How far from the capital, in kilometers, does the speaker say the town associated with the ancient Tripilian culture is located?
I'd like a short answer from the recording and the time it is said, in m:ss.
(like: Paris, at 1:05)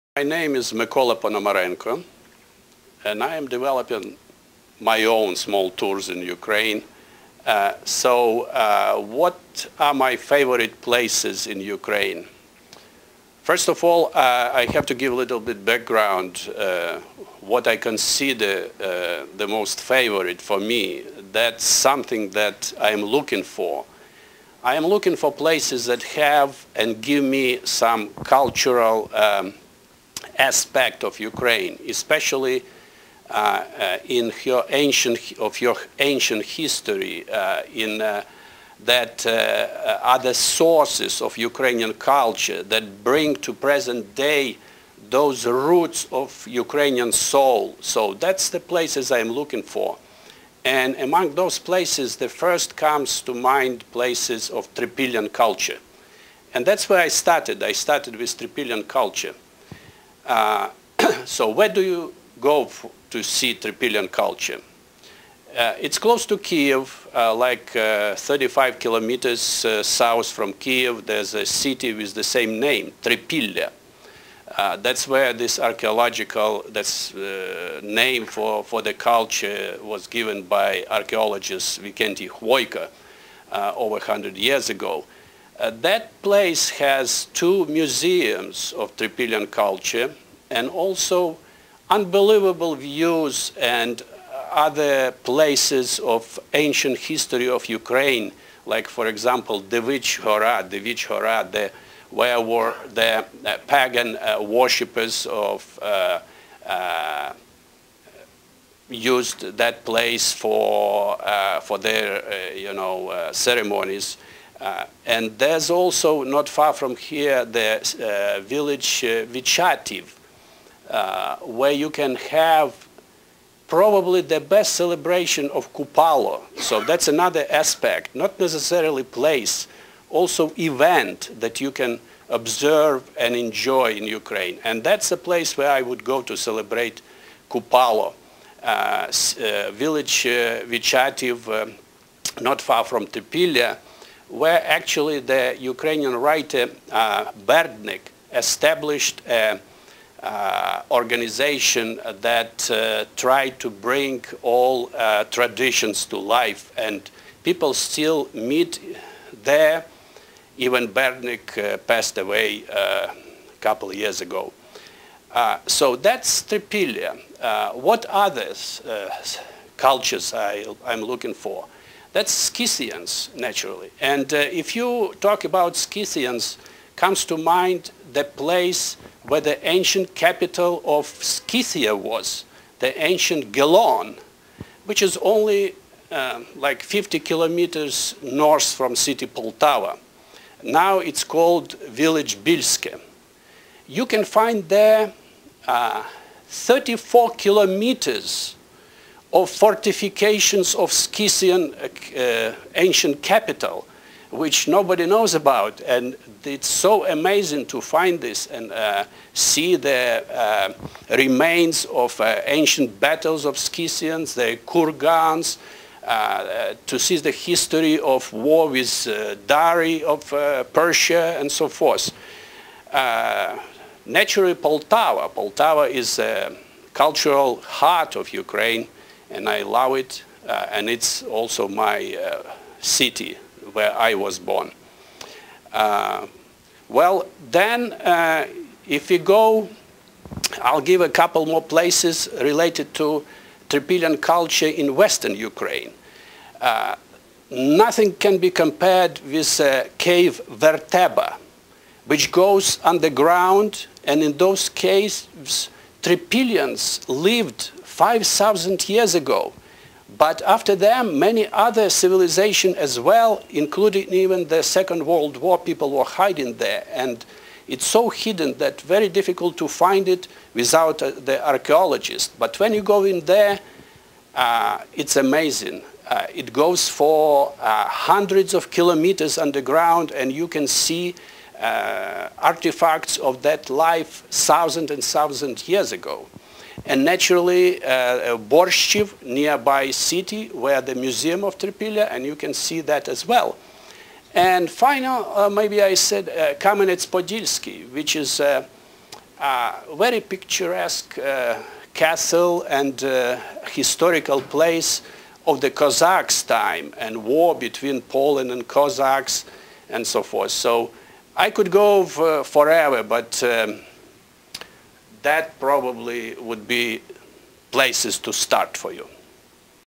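35, at 1:08.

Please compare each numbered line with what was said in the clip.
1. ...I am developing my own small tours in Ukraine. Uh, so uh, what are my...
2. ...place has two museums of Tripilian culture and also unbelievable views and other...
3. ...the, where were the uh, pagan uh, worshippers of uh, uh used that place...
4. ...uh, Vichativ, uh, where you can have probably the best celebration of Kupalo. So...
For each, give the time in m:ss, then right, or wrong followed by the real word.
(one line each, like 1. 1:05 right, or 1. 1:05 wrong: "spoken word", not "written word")
1. 0:03 right
2. 1:26 right
3. 1:41 right
4. 1:59 right.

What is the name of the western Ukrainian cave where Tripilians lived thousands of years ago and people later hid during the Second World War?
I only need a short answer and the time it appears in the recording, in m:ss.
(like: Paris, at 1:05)
Verteba, at 4:10.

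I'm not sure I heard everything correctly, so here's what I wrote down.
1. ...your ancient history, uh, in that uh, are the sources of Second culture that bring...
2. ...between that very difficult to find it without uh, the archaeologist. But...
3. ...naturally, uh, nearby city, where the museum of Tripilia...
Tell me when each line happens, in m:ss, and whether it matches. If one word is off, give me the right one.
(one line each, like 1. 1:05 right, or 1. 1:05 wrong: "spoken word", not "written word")
1. 0:35 wrong: "Ukrainian", not "Second"
2. 4:28 wrong: "hidden", not "between"
3. 4:47 right.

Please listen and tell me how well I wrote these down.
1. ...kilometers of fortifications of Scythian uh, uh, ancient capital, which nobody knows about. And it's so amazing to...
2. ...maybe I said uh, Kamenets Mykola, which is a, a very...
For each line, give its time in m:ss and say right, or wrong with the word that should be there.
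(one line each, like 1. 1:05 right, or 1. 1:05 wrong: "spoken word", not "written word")
1. 3:17 right
2. 4:55 wrong: "Podilsky", not "Mykola".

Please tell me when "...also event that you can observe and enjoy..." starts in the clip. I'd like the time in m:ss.
2:10.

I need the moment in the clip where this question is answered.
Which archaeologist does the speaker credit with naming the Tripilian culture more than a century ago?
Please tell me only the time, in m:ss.
1:21.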